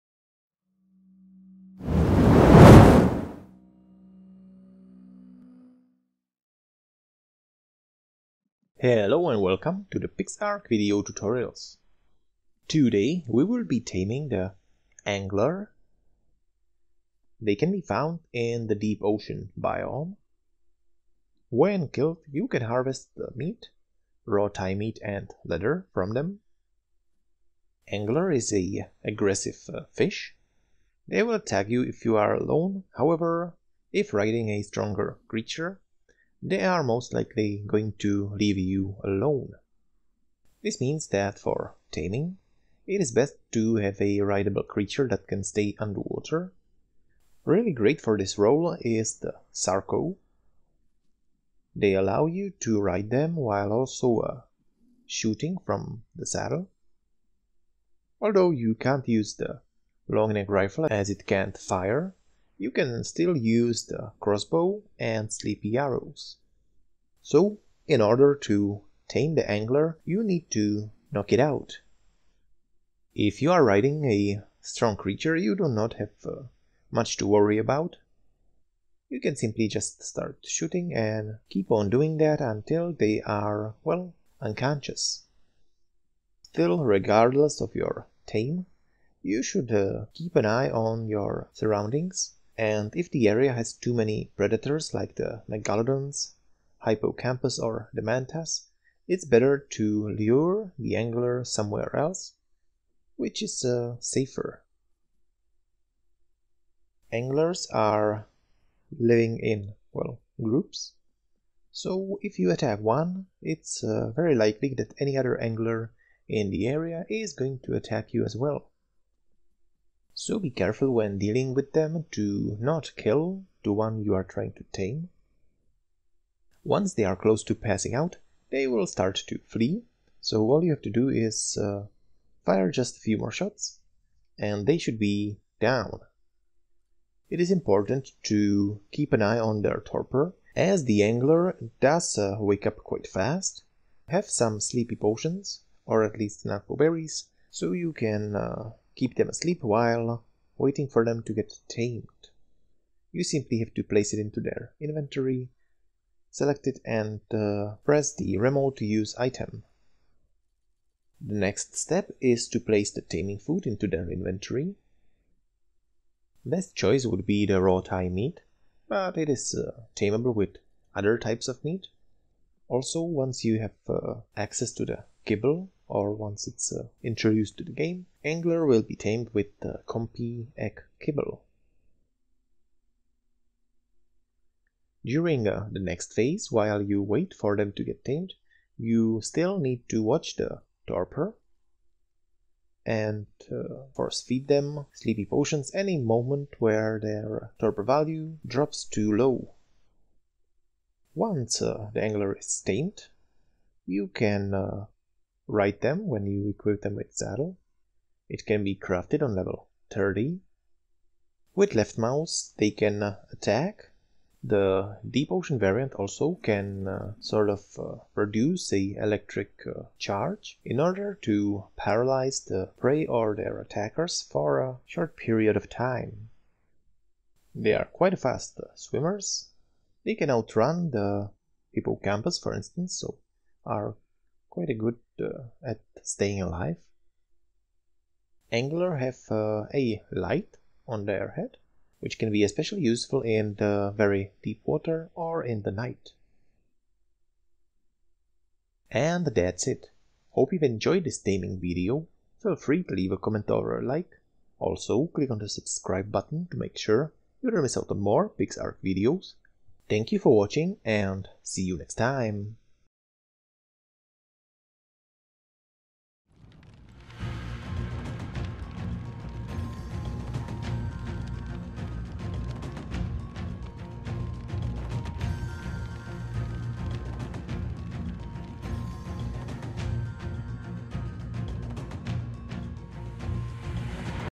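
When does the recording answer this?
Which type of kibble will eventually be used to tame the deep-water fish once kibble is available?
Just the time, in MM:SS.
02:59.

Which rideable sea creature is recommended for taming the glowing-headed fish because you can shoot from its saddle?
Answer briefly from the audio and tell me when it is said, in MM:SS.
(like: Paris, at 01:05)
Sarco, at 00:49.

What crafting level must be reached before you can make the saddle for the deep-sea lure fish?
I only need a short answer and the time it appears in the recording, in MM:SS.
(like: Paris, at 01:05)
30, at 03:29.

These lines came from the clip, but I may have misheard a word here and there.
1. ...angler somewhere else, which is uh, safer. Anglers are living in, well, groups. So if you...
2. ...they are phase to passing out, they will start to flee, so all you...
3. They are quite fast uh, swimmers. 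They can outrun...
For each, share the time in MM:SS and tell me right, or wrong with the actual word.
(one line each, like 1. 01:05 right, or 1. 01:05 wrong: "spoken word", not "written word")
1. 01:40 right
2. 02:06 wrong: "close", not "phase"
3. 03:47 right.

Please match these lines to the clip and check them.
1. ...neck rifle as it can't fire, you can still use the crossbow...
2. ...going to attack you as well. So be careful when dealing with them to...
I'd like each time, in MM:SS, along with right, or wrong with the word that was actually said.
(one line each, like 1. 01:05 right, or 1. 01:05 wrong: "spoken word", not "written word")
1. 01:00 right
2. 01:57 right.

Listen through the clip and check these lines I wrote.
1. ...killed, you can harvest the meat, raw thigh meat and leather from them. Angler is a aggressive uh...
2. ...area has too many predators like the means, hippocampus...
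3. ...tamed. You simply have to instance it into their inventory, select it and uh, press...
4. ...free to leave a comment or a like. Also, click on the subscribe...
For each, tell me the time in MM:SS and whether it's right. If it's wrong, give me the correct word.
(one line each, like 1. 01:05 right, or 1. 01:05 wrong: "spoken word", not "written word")
1. 00:21 right
2. 01:33 wrong: "megalodons", not "means"
3. 02:31 wrong: "place", not "instance"
4. 04:12 right.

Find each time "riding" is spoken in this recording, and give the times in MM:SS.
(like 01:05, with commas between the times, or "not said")
00:34, 01:13.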